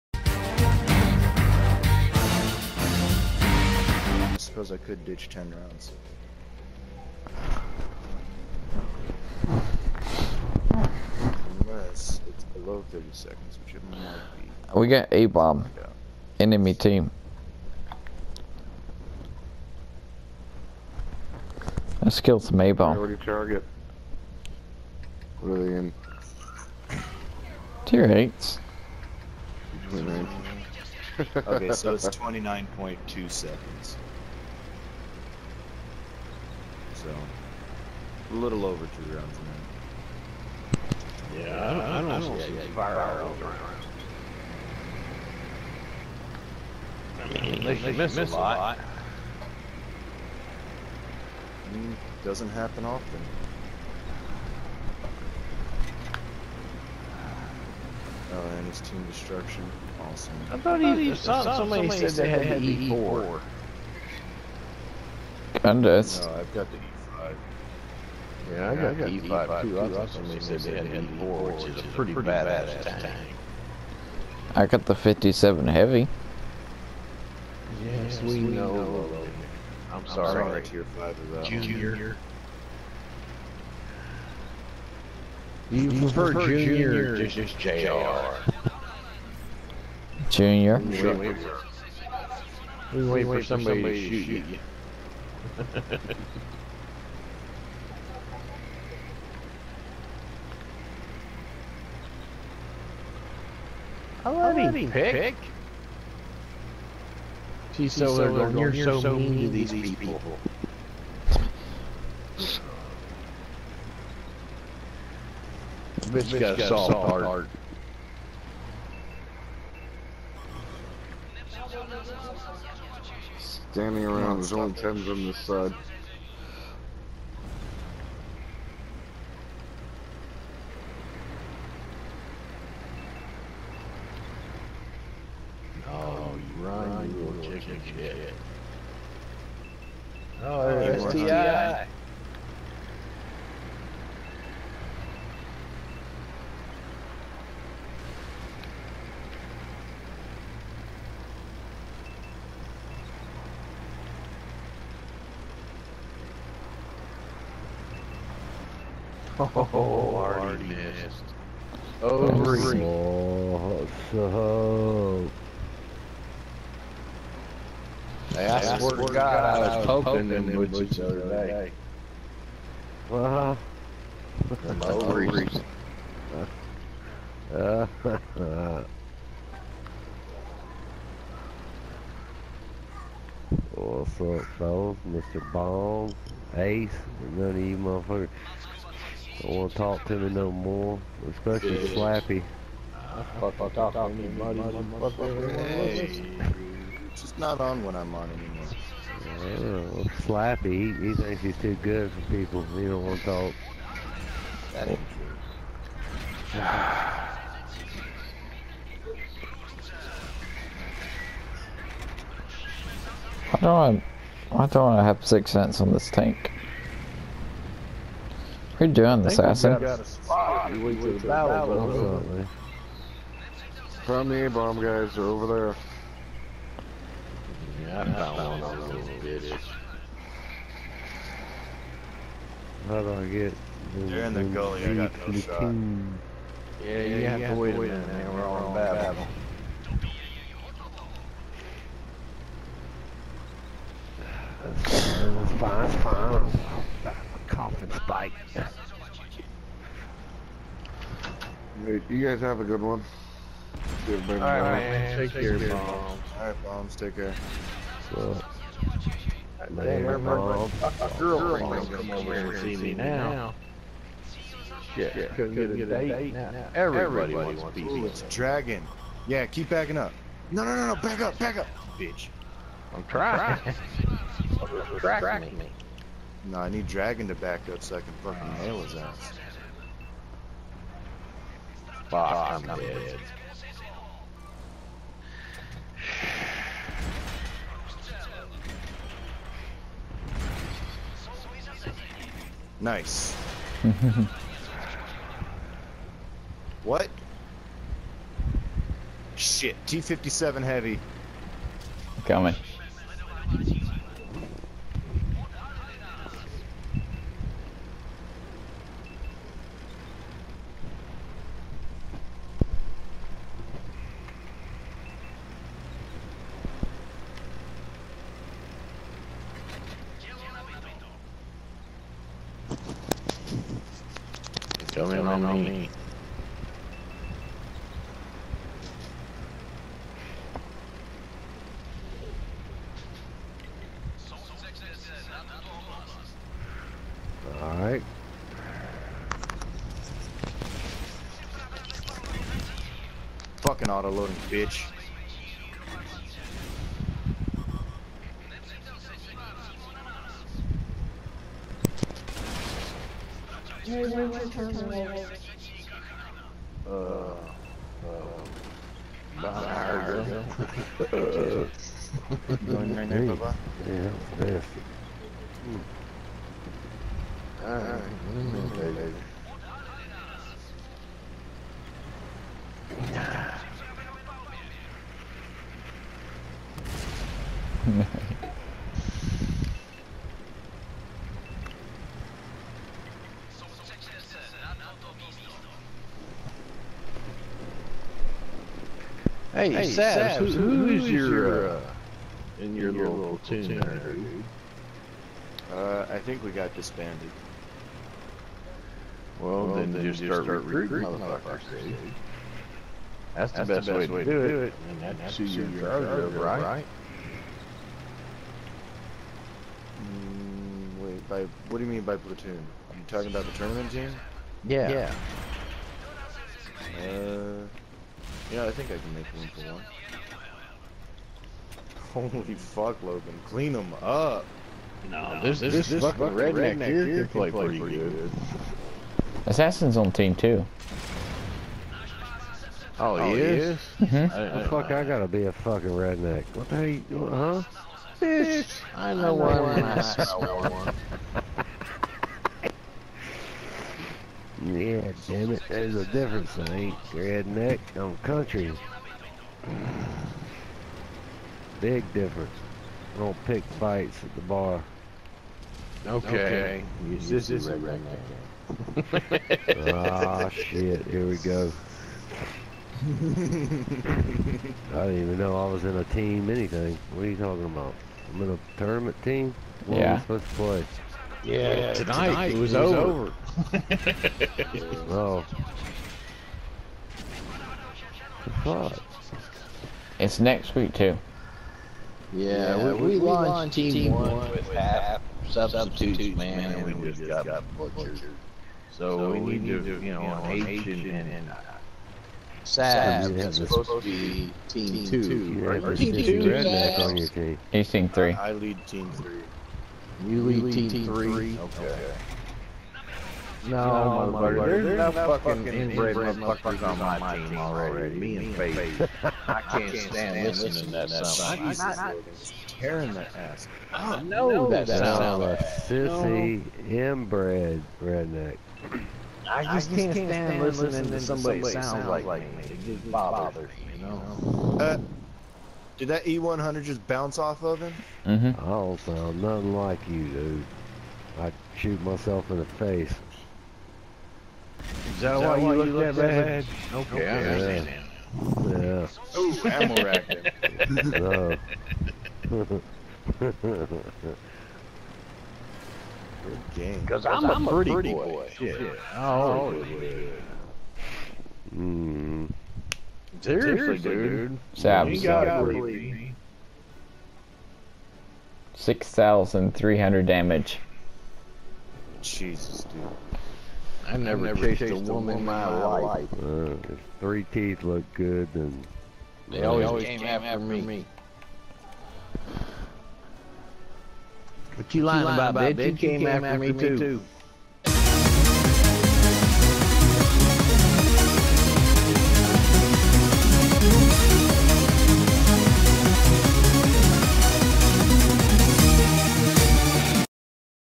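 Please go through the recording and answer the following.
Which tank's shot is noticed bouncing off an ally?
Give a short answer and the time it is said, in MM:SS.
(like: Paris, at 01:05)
E100, at 08:46.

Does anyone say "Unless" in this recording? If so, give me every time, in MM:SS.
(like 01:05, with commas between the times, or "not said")
00:11.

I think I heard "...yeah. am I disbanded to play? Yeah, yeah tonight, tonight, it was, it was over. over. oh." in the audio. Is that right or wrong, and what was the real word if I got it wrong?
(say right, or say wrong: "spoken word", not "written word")
wrong: "supposed", not "disbanded".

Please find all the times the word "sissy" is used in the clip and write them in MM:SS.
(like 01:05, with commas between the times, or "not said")
08:35.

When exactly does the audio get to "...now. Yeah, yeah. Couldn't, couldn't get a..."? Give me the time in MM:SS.
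04:22.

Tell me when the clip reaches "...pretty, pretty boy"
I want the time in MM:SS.
09:07.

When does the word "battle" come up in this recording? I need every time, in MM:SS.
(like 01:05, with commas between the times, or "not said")
03:58.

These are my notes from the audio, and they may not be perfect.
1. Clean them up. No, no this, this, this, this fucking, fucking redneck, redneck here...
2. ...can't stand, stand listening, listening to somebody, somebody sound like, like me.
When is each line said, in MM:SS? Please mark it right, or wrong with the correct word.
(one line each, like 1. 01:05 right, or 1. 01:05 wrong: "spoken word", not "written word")
1. 07:03 right
2. 08:40 right.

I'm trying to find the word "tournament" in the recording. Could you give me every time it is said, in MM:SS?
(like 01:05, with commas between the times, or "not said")
06:53, 07:48.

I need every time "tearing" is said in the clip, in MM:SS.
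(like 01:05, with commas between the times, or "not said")
08:32.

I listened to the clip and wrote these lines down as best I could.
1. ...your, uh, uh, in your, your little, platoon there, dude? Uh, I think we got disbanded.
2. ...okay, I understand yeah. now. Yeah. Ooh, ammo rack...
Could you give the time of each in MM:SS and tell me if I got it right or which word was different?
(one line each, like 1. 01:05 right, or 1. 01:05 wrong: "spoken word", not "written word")
1. 06:31 right
2. 08:57 right.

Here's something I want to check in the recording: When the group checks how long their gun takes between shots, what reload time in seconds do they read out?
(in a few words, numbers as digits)
29.2.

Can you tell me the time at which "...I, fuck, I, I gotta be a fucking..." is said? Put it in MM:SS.
07:14.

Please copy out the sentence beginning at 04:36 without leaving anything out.
No, I need Dragon to back up so I can fucking nail his ass.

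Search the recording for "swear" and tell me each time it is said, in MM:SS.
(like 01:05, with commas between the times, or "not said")
02:48.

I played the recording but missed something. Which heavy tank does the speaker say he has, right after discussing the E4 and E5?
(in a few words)
T-57 Heavy.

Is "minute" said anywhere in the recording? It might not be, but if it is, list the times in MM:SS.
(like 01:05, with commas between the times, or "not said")
00:41, 03:57.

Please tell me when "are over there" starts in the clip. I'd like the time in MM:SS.
03:45.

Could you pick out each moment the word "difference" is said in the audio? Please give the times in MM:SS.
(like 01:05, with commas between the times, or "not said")
07:26, 07:32.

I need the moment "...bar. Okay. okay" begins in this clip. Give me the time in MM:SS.
07:34.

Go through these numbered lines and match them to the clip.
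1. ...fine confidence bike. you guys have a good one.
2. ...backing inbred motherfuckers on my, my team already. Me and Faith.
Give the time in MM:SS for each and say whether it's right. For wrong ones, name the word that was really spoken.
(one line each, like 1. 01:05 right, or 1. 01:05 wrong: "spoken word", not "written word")
1. 04:06 right
2. 08:25 wrong: "fucking", not "backing".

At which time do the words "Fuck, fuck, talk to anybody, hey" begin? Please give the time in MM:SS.
03:13.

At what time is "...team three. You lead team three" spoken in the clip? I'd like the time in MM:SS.
08:18.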